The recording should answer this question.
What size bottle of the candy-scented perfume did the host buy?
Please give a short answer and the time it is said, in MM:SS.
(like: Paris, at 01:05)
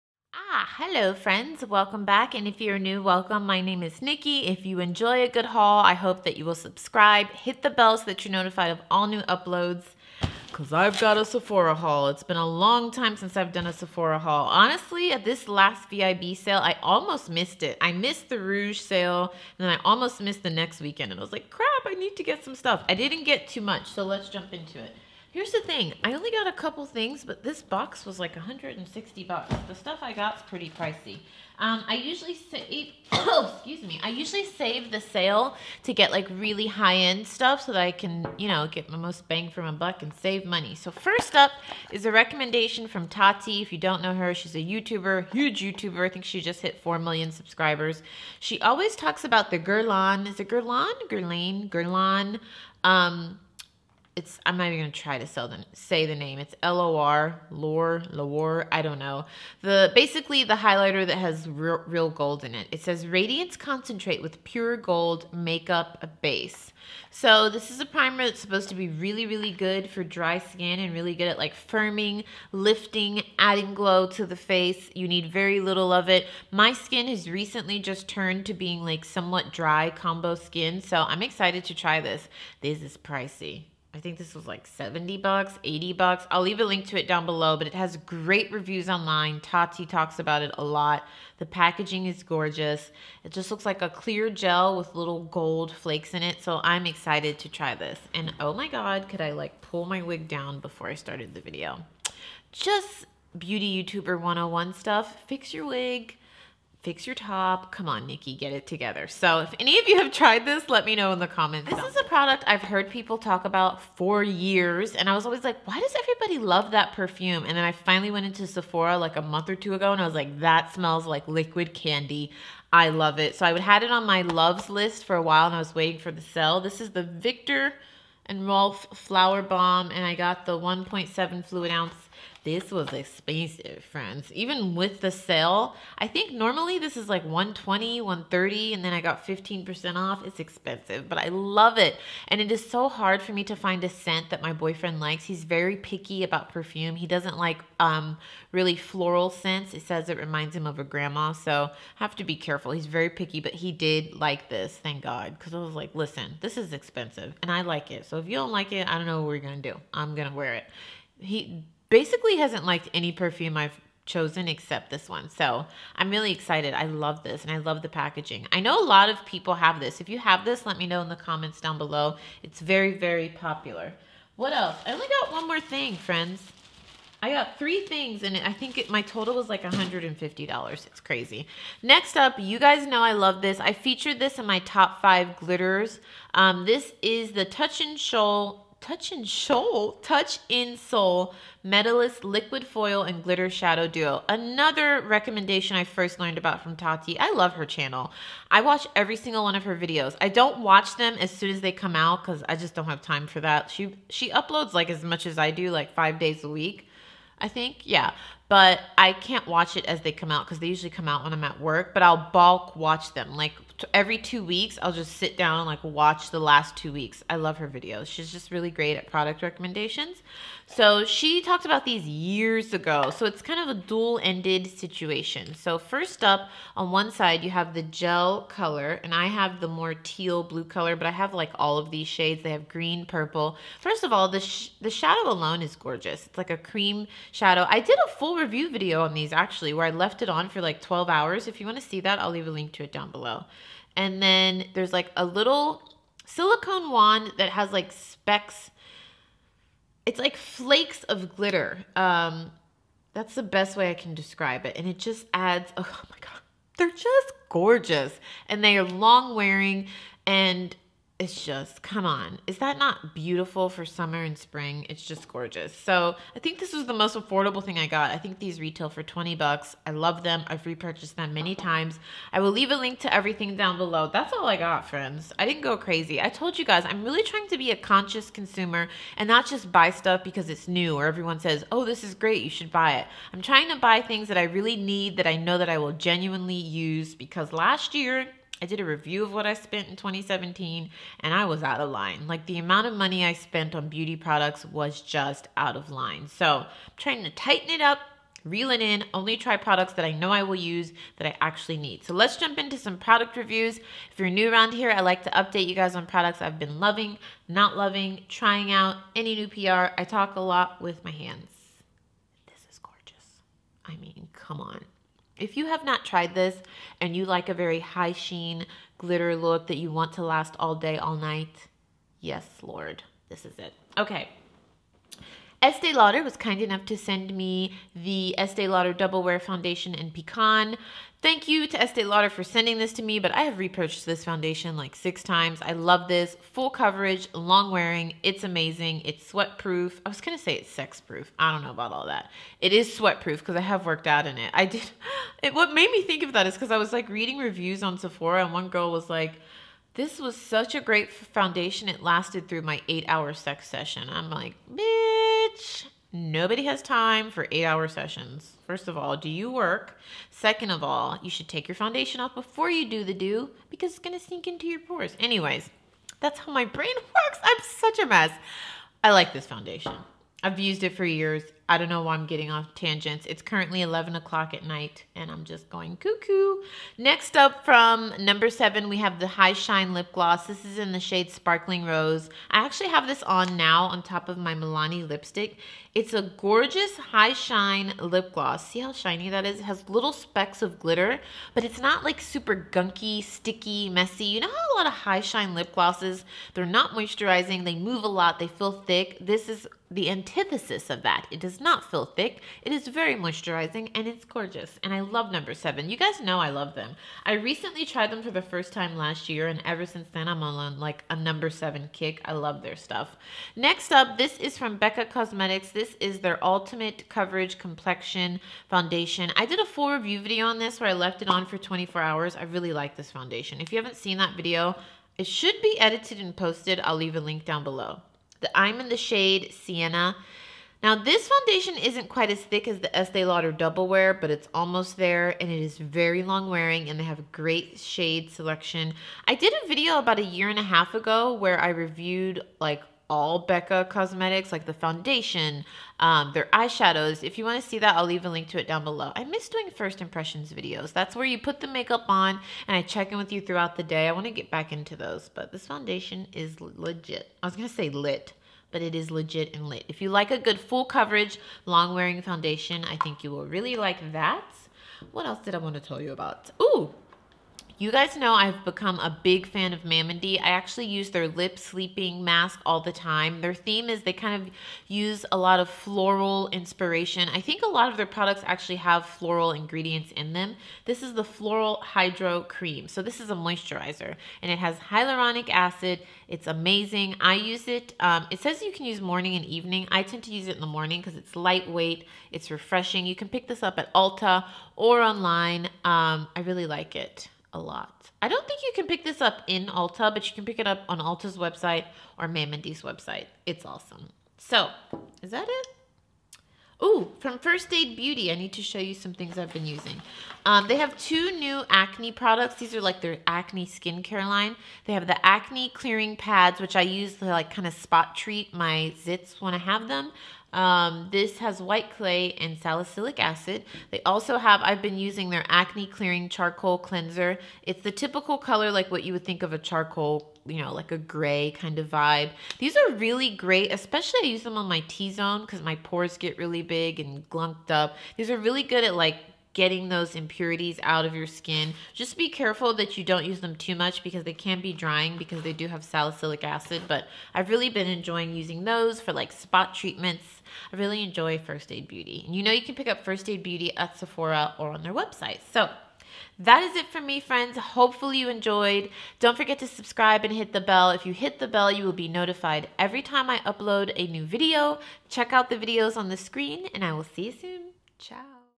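1.7 fluid ounce, at 02:10.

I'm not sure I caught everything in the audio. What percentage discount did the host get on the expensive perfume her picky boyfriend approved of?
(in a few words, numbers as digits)
15%.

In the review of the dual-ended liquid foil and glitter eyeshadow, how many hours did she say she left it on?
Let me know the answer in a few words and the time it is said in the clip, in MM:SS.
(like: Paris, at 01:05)
12 hours, at 04:00.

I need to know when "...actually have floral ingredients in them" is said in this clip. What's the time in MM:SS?
07:58.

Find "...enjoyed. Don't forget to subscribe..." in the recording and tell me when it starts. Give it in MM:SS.
09:18.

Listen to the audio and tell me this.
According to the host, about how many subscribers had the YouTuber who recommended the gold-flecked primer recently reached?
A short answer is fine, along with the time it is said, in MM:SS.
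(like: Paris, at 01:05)
4 million, at 00:46.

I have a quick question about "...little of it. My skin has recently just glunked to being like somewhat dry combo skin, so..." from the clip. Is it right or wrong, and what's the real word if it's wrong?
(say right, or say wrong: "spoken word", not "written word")
wrong: "turned", not "glunked".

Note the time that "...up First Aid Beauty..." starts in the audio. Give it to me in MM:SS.
09:12.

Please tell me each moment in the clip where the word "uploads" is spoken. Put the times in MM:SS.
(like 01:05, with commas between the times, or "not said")
00:09, 03:24, 09:23.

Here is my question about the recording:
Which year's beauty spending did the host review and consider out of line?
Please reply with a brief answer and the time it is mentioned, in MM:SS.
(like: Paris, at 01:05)
2017, at 04:49.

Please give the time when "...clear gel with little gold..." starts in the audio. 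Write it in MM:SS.
01:33.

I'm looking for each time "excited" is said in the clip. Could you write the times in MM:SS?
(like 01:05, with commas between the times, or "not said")
01:21, 01:36, 02:46.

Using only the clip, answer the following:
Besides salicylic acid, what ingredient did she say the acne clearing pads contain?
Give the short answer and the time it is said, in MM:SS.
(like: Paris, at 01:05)
white clay, at 08:41.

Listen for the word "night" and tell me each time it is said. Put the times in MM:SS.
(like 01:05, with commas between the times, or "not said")
05:21, 06:14.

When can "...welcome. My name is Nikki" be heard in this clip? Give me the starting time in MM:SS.
00:03.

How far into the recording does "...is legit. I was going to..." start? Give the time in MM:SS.
07:36.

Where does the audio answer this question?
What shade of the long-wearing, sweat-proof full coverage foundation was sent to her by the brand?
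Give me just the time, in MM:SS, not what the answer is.
05:30.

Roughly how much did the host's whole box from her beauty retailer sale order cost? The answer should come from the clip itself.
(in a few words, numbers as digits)
160 bucks.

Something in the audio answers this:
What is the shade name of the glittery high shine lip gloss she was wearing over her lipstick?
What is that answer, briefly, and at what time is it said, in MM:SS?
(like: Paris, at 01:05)
Sparkling Rose, at 06:21.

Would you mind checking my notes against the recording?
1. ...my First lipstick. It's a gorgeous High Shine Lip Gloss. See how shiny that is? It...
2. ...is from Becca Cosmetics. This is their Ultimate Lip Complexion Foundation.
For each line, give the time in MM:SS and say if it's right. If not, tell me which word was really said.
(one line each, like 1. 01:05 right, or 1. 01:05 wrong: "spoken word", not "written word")
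1. 06:24 wrong: "Milani", not "First"
2. 06:54 wrong: "Coverage", not "Lip".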